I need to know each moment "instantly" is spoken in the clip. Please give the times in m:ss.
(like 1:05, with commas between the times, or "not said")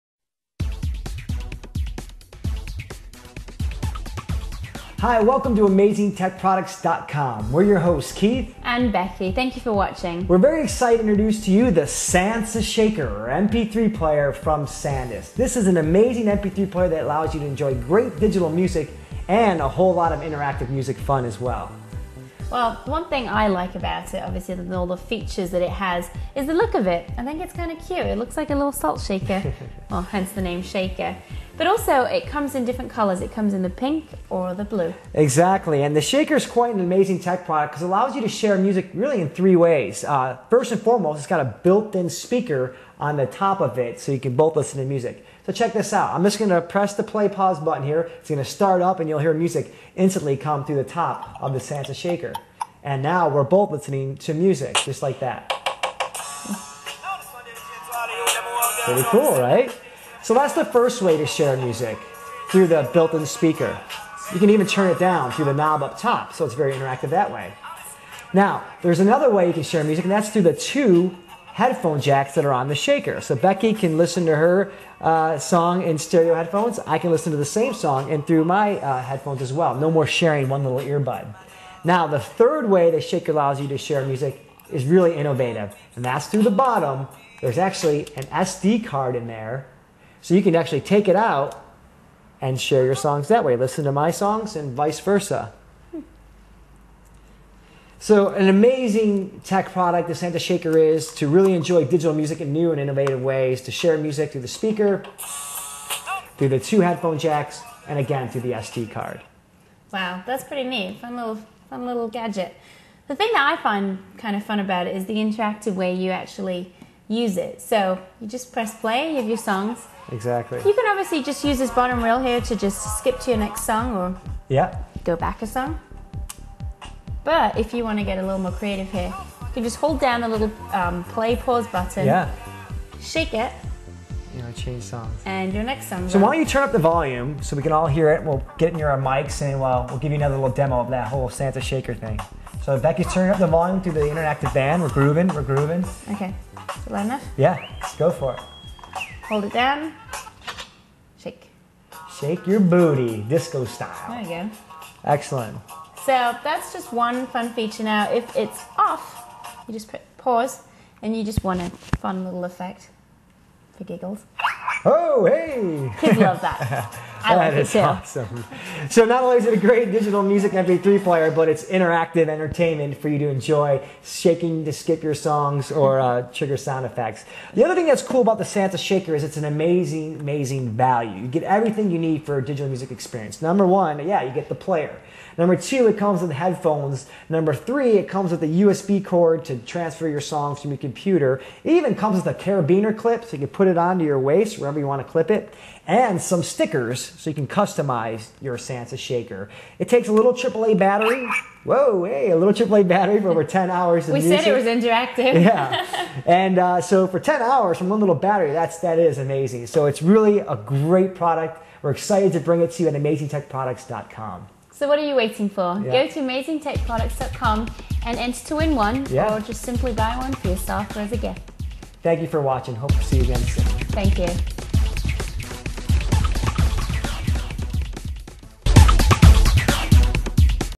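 0:49.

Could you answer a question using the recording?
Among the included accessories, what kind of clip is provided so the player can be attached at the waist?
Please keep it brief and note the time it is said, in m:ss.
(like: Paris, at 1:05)
Carabiner clip, at 3:12.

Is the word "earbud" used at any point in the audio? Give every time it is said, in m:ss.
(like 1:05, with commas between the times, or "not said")
1:20.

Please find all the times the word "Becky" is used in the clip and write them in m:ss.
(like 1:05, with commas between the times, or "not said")
0:08, 1:13, 2:22.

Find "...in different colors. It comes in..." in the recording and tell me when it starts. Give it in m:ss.
0:32.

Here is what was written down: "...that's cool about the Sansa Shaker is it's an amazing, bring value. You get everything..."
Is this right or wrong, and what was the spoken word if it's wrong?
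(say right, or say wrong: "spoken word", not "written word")
wrong: "amazing", not "bring".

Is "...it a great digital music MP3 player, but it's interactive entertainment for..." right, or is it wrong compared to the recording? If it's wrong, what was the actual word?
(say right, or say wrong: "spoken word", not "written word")
right.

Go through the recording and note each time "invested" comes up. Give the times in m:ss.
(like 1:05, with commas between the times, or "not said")
not said.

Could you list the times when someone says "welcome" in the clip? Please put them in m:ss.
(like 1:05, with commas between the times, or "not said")
0:05.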